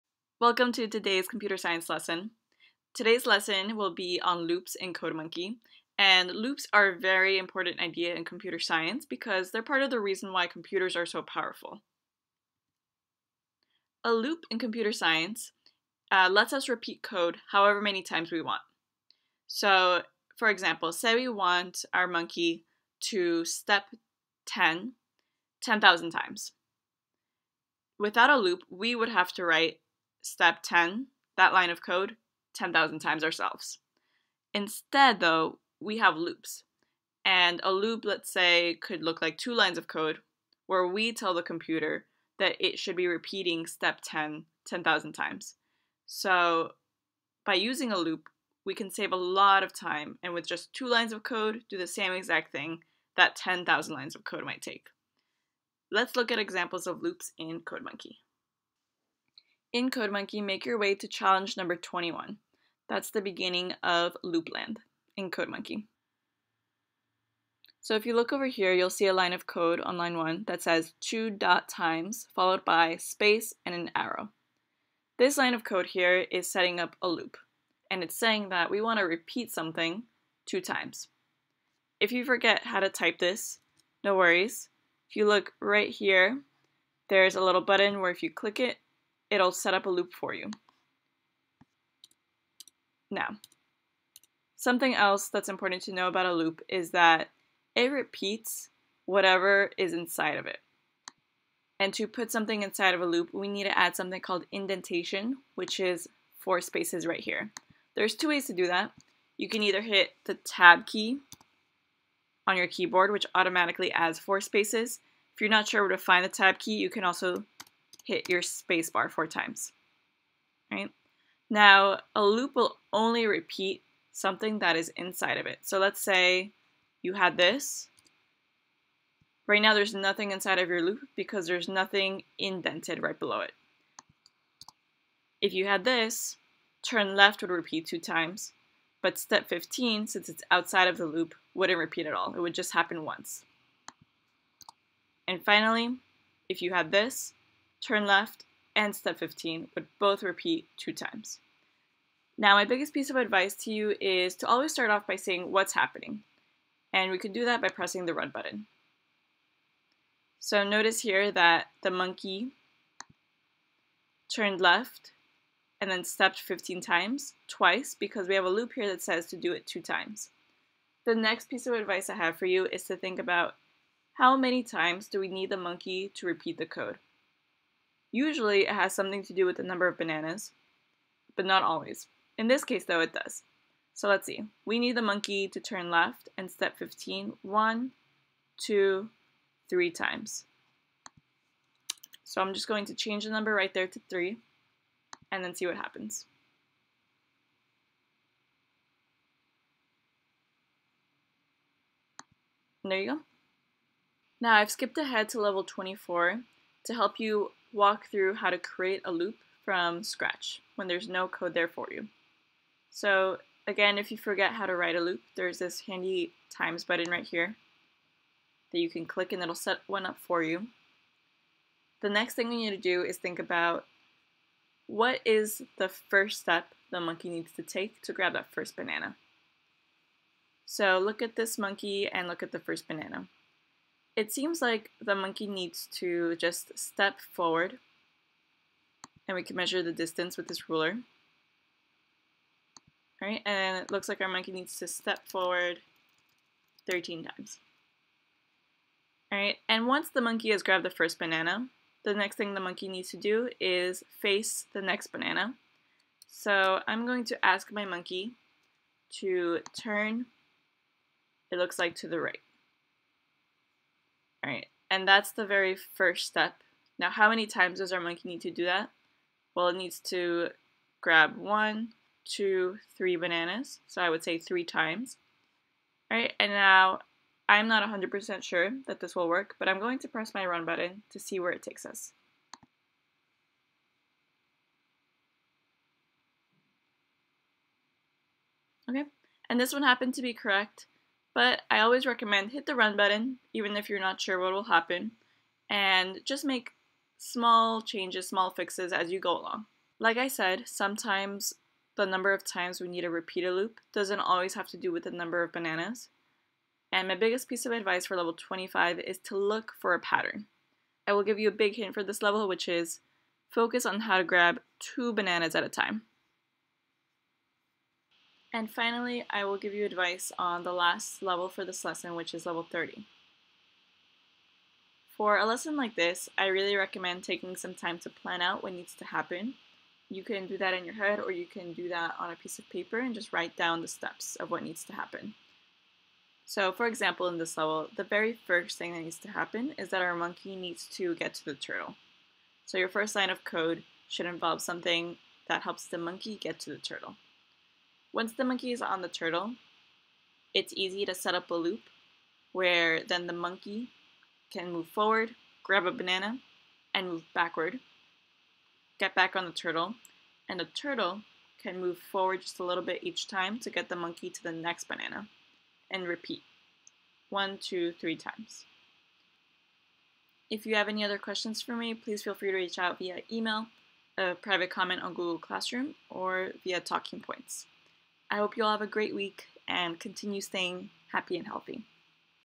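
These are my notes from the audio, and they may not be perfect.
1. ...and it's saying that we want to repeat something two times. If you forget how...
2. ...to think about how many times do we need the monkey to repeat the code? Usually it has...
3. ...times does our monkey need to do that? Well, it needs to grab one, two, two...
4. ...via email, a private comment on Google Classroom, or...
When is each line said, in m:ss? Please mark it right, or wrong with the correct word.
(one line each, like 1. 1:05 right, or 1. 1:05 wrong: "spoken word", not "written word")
1. 1:17 right
2. 2:52 right
3. 4:27 wrong: "three", not "two"
4. 6:12 right.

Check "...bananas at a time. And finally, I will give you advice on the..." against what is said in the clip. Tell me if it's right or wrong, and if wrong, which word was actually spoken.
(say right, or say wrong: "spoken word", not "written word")
right.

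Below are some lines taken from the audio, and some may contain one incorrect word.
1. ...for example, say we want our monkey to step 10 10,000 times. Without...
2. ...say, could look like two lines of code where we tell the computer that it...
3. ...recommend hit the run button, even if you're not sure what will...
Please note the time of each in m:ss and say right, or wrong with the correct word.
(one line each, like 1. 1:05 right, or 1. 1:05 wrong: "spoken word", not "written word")
1. 0:20 right
2. 0:38 right
3. 4:52 right.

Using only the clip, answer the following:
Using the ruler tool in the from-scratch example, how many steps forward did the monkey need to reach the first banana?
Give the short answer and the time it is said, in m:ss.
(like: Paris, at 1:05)
13, at 4:06.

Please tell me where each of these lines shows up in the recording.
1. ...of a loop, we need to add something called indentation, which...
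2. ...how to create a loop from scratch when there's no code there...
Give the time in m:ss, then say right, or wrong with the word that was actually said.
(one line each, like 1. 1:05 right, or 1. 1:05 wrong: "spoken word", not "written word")
1. 1:42 right
2. 3:28 right.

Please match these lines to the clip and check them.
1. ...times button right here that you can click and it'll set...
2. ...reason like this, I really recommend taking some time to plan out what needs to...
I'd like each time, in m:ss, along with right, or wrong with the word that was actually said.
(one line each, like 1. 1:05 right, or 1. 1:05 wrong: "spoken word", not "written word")
1. 3:36 right
2. 5:25 wrong: "lesson", not "reason".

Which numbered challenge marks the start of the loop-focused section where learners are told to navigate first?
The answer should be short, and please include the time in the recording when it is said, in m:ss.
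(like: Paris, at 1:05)
21, at 1:01.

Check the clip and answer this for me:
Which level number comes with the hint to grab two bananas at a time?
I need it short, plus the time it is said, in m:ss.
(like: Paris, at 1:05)
25, at 5:08.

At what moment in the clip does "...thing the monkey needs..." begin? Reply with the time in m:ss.
4:12.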